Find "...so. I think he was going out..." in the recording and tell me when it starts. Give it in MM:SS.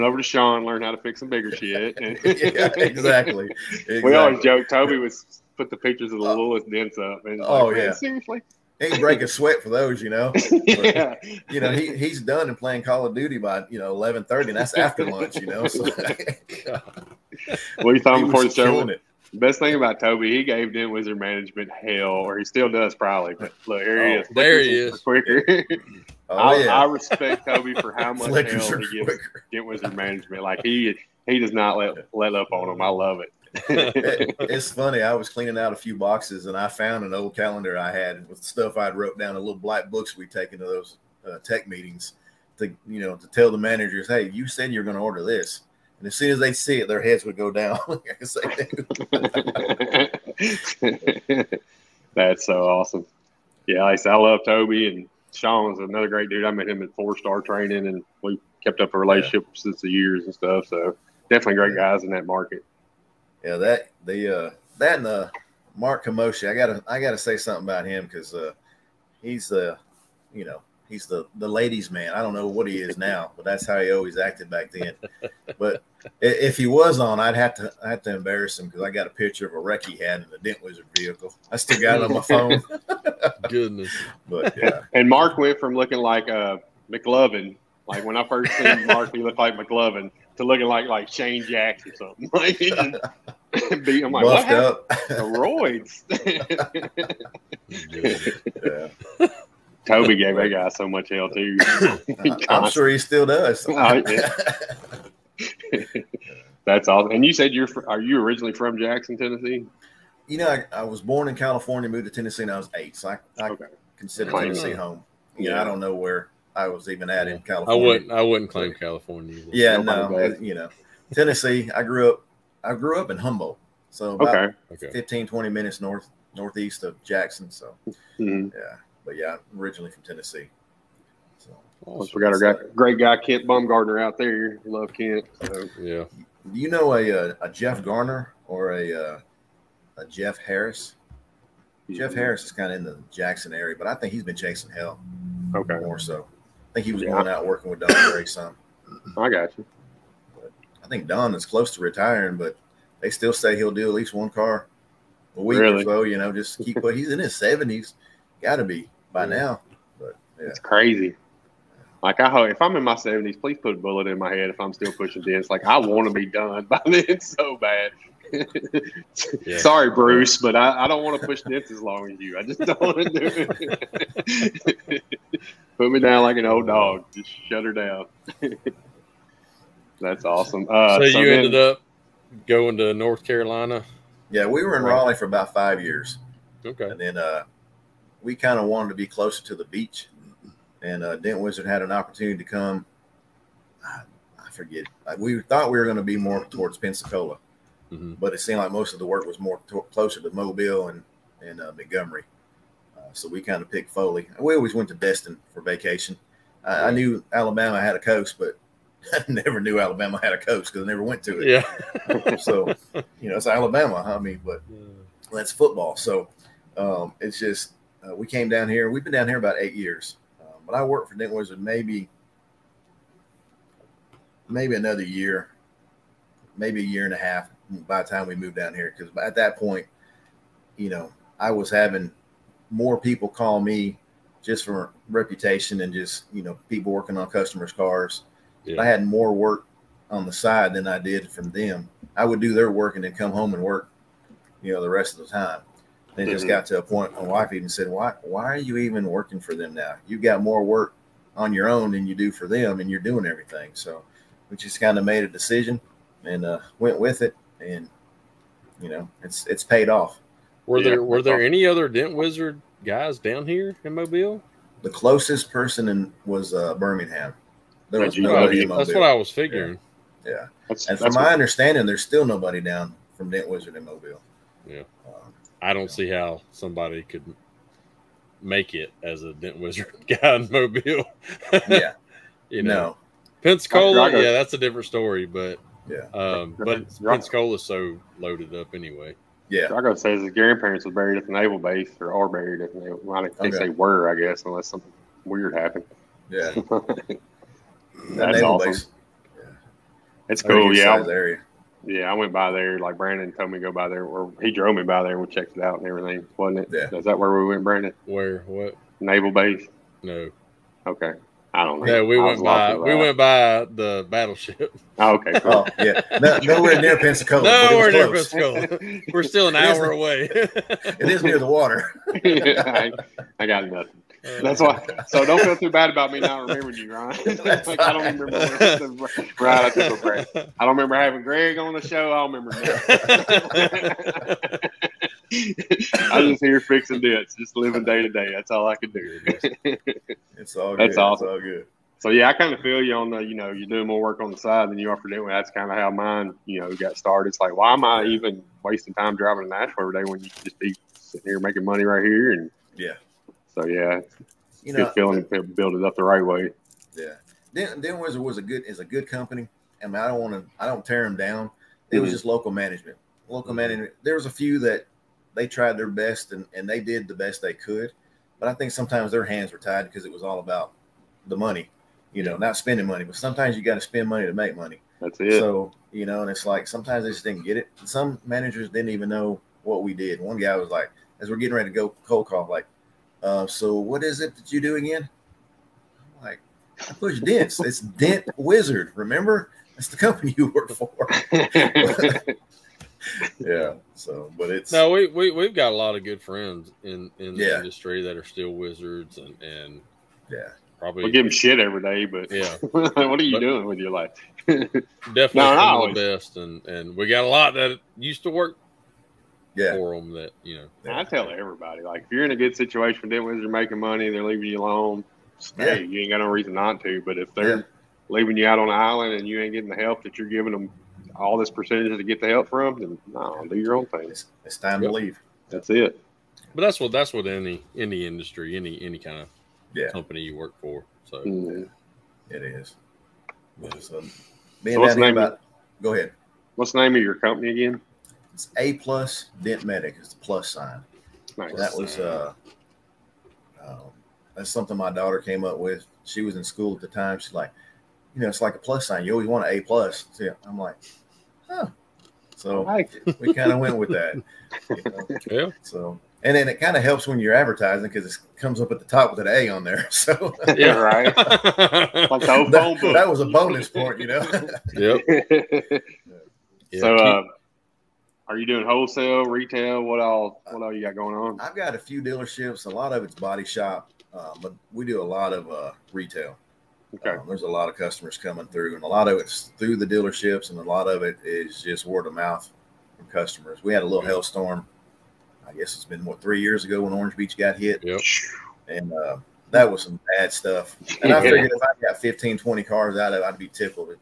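02:25.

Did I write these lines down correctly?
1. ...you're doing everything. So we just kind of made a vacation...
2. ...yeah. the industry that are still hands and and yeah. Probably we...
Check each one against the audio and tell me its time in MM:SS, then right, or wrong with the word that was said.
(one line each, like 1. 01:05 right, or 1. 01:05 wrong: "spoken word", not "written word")
1. 04:12 wrong: "decision", not "vacation"
2. 06:37 wrong: "wizards", not "hands".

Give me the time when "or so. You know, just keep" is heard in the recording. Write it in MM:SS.
02:35.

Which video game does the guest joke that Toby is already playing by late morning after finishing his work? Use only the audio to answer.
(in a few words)
Call of Duty.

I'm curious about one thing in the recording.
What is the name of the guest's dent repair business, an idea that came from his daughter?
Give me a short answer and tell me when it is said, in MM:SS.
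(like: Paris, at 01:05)
A Plus Dent Medic, at 07:18.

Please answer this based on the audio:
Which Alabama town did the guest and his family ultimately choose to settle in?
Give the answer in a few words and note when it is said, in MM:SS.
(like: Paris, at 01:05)
Foley, at 03:23.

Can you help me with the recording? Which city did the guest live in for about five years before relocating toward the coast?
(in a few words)
Raleigh.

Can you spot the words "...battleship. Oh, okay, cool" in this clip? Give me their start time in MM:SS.
05:14.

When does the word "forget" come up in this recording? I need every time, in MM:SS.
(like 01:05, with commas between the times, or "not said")
03:14.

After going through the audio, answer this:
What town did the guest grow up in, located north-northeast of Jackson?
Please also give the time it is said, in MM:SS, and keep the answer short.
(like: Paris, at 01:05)
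Humboldt, at 02:03.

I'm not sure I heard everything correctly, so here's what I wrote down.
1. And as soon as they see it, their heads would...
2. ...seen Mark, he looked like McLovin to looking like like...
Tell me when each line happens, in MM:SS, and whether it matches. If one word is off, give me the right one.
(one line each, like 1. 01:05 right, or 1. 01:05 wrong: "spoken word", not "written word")
1. 00:45 right
2. 01:28 right.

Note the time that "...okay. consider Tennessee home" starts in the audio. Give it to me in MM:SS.
01:53.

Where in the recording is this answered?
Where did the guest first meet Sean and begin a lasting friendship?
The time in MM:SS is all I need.
00:56.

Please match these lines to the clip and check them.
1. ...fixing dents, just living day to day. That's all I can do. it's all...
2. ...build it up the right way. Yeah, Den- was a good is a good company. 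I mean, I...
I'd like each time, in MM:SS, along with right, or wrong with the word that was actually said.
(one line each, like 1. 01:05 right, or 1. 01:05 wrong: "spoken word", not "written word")
1. 05:36 right
2. 05:55 right.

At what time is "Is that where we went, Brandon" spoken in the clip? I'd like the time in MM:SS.
05:06.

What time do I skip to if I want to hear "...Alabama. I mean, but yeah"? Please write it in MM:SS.
03:33.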